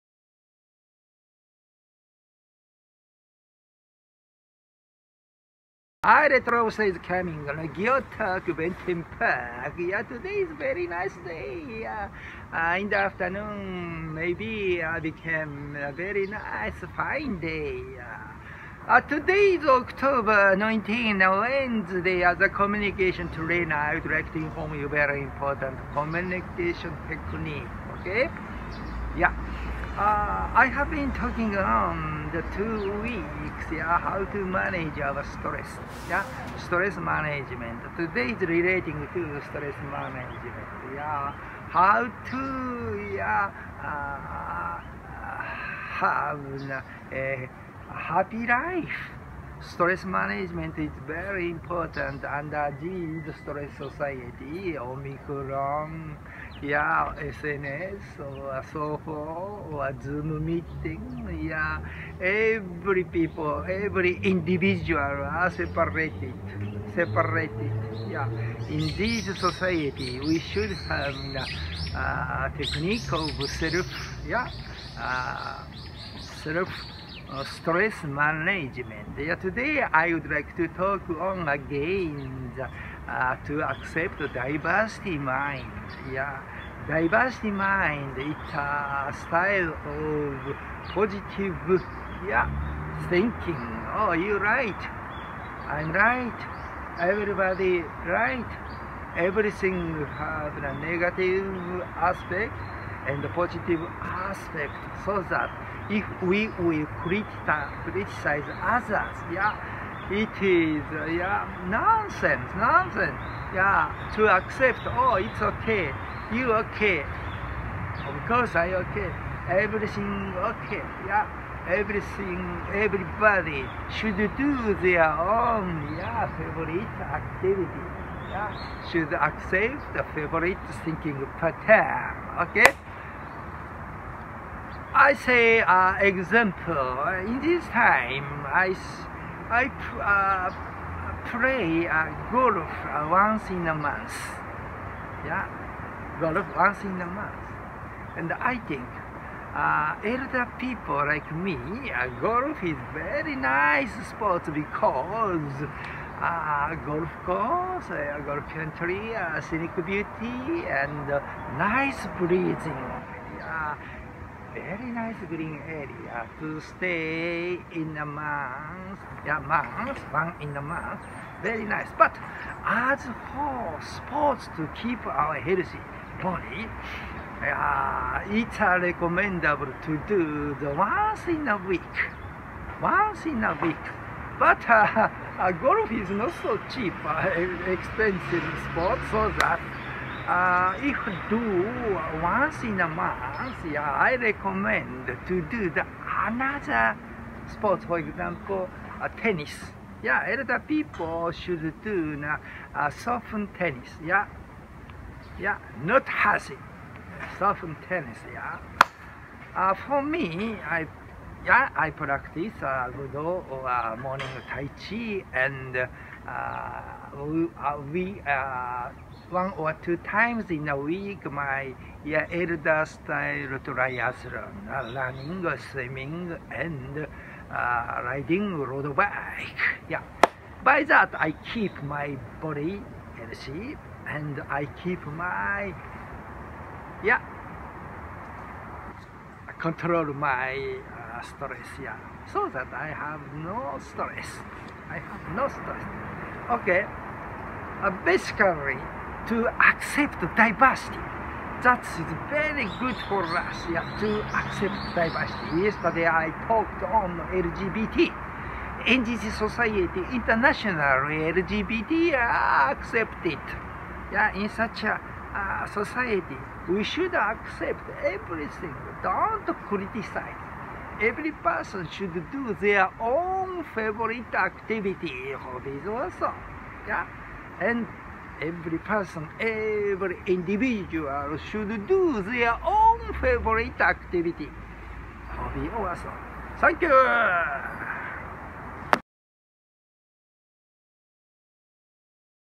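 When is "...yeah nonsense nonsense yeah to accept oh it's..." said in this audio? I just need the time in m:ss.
1:51.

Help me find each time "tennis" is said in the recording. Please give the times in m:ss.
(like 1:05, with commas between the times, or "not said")
3:19, 3:23, 3:27.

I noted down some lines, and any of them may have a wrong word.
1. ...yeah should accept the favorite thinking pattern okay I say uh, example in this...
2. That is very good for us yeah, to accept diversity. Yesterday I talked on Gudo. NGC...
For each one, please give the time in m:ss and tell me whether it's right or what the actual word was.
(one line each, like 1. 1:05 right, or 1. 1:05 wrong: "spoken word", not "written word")
1. 2:08 right
2. 4:11 wrong: "LGBT", not "Gudo".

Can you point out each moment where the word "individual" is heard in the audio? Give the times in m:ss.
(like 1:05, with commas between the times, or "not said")
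1:04, 4:40.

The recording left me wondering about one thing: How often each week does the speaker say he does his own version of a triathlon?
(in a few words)
1 or 2 times.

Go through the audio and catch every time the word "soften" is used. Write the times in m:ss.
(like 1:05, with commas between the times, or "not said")
3:22, 3:27.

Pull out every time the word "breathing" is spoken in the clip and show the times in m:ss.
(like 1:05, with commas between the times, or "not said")
2:42.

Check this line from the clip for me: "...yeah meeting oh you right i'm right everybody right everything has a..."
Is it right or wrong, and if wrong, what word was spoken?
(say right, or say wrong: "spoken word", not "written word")
wrong: "thinking", not "meeting".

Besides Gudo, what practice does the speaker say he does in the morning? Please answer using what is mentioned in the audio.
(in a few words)
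Tai Chi.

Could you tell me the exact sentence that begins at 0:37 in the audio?
Today is relating to stress management, yeah, how to, yeah, uh, uh have a happy life.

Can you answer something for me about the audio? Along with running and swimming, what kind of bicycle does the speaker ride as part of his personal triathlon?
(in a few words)
road bike.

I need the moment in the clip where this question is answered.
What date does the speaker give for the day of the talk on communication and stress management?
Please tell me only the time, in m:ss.
0:19.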